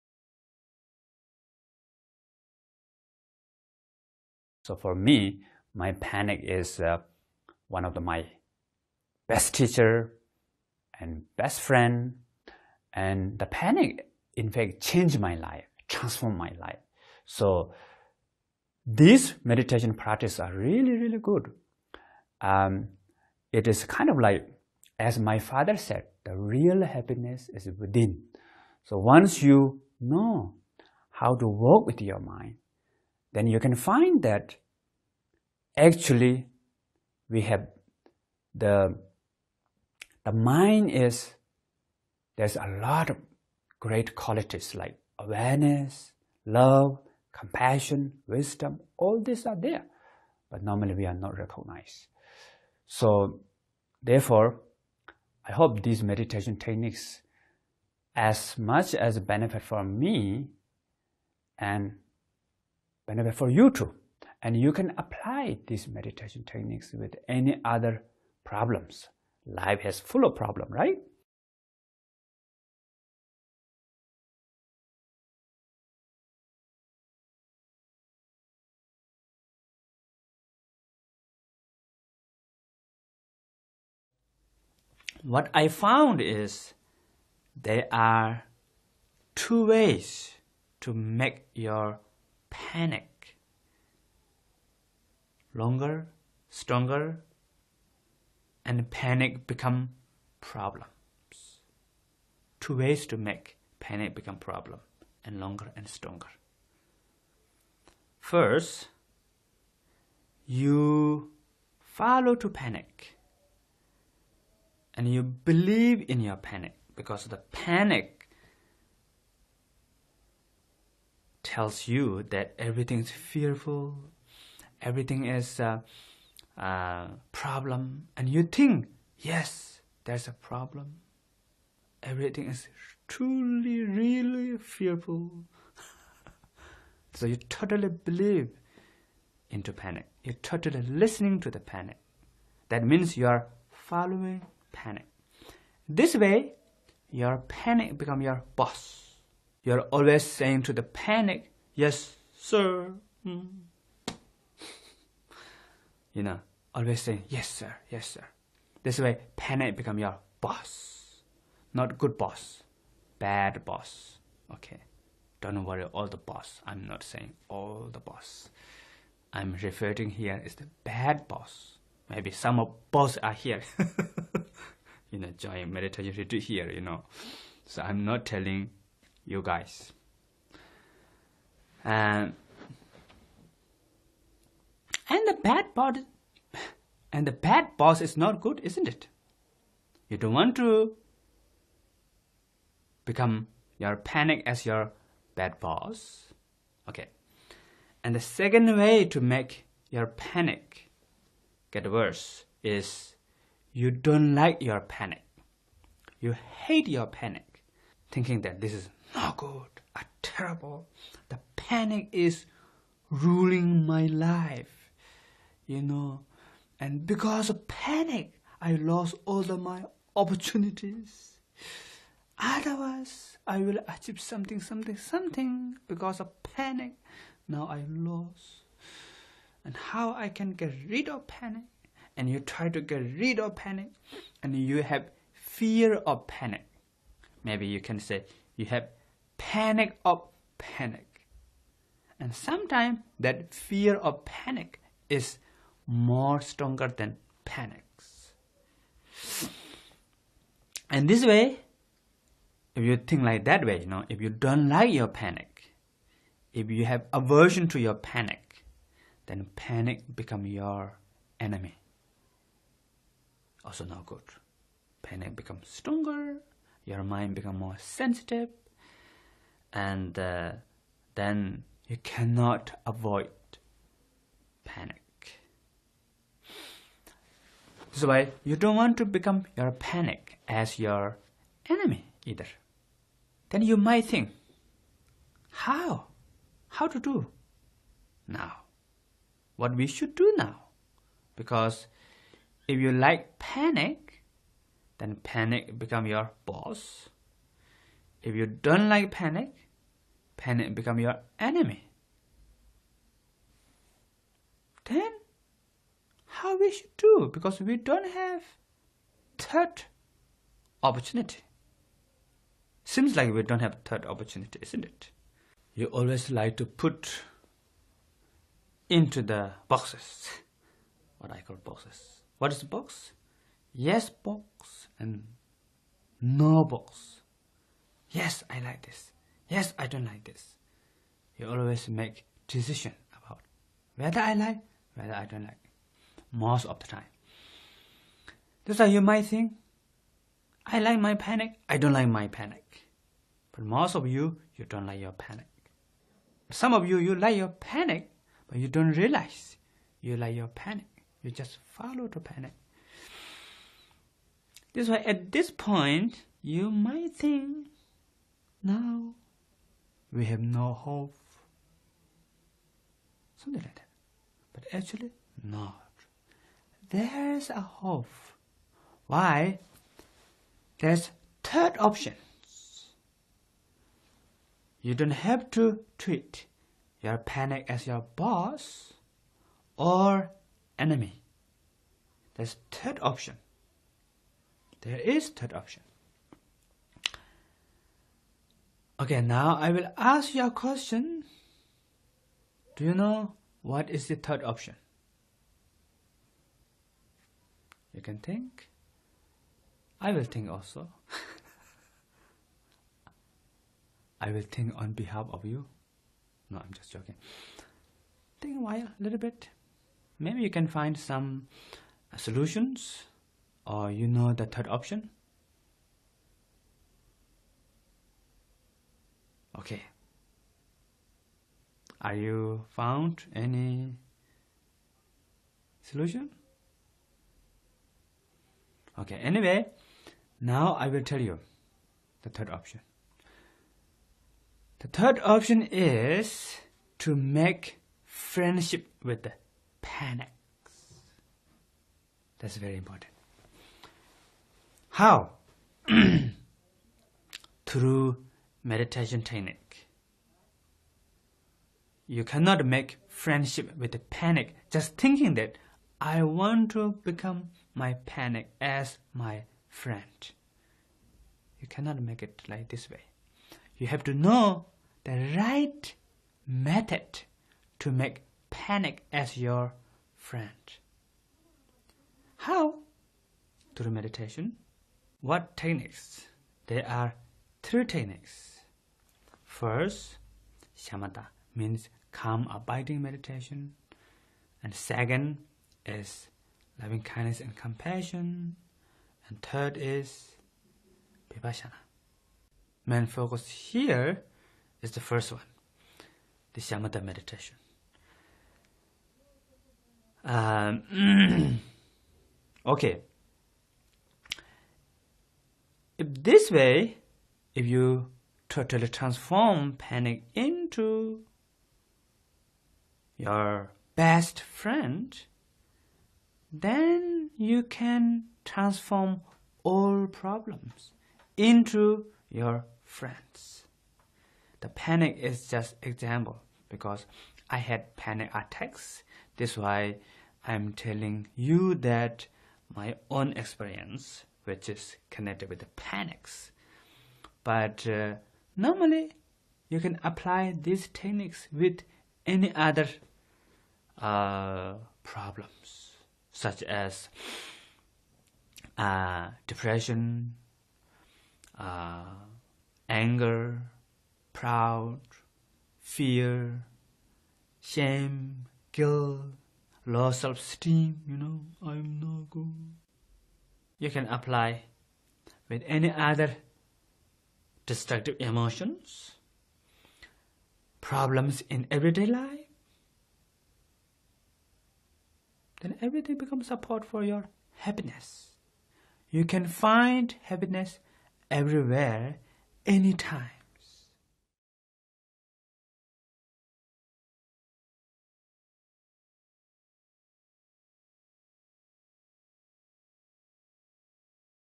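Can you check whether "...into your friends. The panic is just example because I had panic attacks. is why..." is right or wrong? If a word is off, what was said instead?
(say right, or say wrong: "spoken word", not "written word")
right.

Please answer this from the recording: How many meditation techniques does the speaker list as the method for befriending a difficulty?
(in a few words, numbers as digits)
3.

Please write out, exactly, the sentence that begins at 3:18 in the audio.
And the second way to make your panic get worse is you don't like your panic.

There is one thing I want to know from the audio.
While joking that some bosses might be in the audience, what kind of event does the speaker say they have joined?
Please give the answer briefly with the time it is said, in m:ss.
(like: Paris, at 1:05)
Meditation retreat, at 2:55.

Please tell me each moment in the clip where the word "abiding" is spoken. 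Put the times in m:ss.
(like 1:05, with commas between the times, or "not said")
8:02.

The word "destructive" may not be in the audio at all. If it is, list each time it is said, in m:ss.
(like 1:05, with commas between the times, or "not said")
9:27.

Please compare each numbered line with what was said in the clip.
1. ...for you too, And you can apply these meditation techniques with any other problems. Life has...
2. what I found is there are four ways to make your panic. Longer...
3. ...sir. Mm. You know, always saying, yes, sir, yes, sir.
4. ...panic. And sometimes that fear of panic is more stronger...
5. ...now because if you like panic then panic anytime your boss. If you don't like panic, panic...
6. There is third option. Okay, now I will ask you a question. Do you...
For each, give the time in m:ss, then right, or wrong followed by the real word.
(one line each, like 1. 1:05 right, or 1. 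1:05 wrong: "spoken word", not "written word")
1. 1:03 right
2. 1:25 wrong: "two", not "four"
3. 2:32 right
4. 4:00 right
5. 4:50 wrong: "become", not "anytime"
6. 6:24 right.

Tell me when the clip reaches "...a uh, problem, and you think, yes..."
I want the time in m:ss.
2:06.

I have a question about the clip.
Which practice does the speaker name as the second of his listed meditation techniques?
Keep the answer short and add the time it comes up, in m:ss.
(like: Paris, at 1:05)
Loving kindness and compassion, at 8:06.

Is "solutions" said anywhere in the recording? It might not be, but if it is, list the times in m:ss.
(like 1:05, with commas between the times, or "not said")
6:52, 7:05.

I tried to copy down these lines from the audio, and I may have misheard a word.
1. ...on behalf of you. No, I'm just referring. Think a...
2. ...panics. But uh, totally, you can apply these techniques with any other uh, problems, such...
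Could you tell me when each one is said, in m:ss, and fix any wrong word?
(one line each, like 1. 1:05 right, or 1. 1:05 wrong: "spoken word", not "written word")
1. 6:44 wrong: "joking", not "referring"
2. 8:55 wrong: "normally", not "totally".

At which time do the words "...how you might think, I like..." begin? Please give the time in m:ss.
5:38.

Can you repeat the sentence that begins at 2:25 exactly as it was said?
This way, your panic become your boss.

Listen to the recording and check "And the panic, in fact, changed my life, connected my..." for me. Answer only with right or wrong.
wrong.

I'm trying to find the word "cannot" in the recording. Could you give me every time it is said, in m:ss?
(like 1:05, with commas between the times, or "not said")
4:32, 7:32, 7:41.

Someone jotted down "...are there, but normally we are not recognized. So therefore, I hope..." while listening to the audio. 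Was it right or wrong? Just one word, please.
right.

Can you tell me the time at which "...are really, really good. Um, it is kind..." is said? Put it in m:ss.
0:20.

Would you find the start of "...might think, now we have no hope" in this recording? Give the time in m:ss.
5:56.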